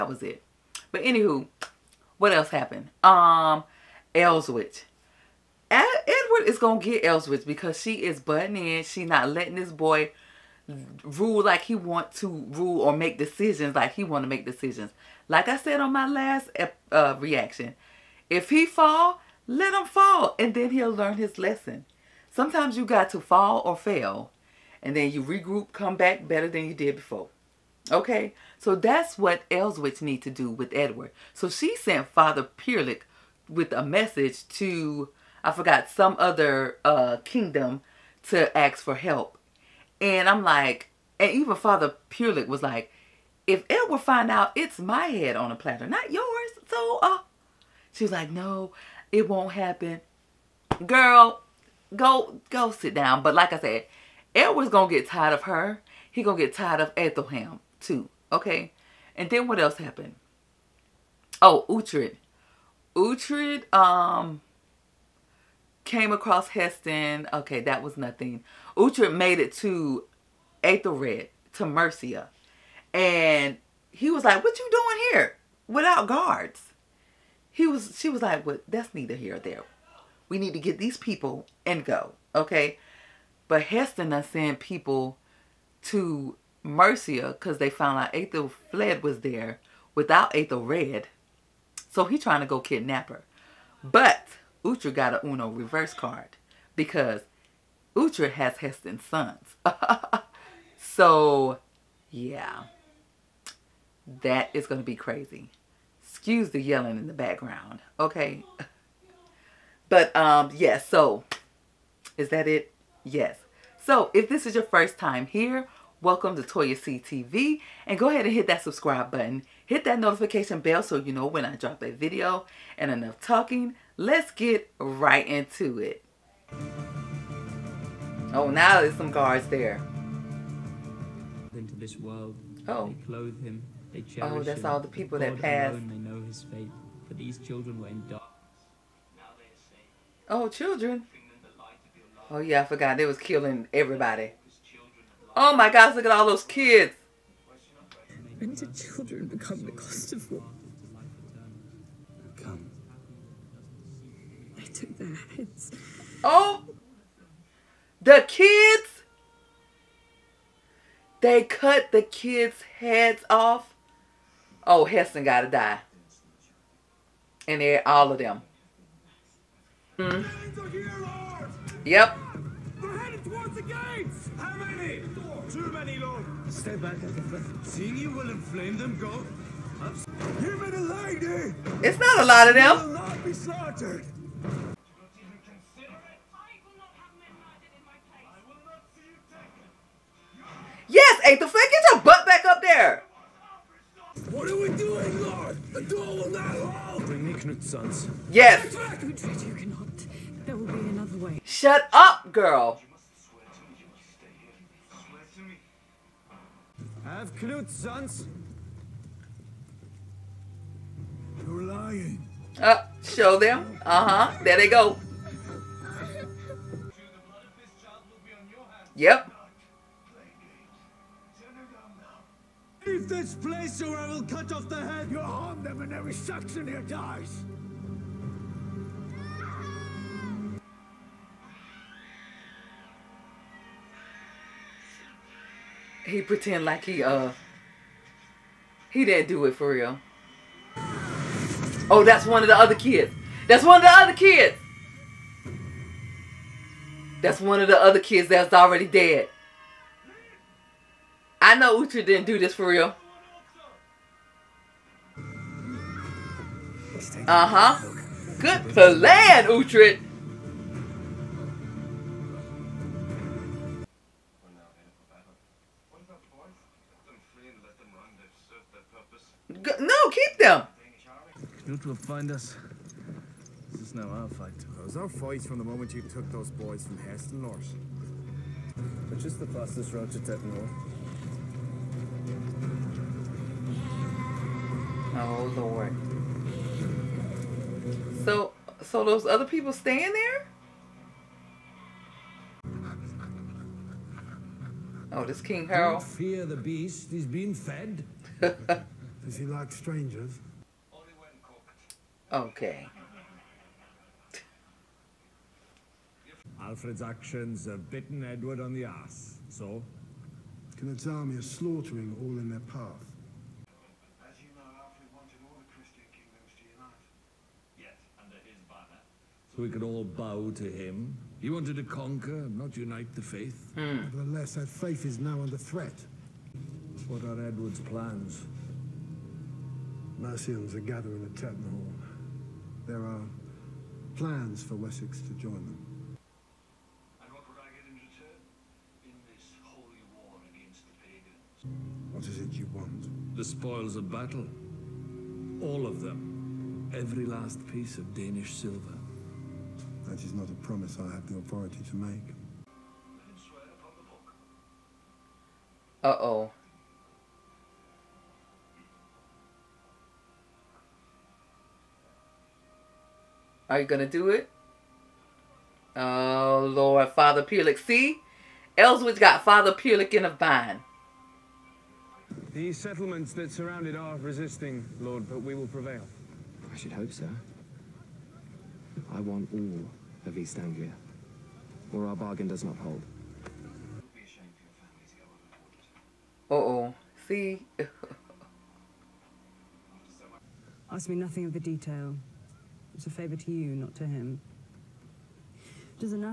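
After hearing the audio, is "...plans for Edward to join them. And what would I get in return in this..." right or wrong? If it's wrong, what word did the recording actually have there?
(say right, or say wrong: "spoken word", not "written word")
wrong: "Wessex", not "Edward".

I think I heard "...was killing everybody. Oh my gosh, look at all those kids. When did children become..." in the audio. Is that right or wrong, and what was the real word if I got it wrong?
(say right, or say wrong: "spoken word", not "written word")
right.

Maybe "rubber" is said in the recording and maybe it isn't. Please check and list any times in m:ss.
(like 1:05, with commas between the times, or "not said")
not said.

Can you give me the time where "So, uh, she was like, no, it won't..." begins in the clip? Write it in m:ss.
0:46.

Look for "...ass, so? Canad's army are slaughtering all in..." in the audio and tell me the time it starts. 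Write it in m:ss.
5:08.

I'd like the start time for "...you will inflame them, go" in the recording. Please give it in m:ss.
2:57.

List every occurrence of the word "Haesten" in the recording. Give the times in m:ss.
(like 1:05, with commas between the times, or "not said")
1:06, 1:23, 1:38, 2:44, 4:36.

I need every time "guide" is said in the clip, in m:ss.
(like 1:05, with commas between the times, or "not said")
not said.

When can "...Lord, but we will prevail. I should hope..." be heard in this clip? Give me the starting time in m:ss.
6:14.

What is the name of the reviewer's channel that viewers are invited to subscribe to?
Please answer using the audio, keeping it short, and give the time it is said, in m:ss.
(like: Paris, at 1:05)
Toya C TV, at 1:56.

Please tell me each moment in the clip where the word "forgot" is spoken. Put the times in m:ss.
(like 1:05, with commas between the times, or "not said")
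0:35, 2:22.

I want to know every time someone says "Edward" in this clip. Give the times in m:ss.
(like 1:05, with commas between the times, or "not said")
0:05, 0:30, 0:54, 5:08, 5:27.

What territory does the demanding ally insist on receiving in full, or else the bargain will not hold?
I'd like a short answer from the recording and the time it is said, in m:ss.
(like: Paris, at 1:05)
East Anglia, at 6:20.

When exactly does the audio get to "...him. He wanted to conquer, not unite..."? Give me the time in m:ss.
5:20.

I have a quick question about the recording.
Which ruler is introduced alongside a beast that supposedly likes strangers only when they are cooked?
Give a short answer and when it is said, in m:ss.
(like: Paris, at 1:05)
King Harold, at 4:55.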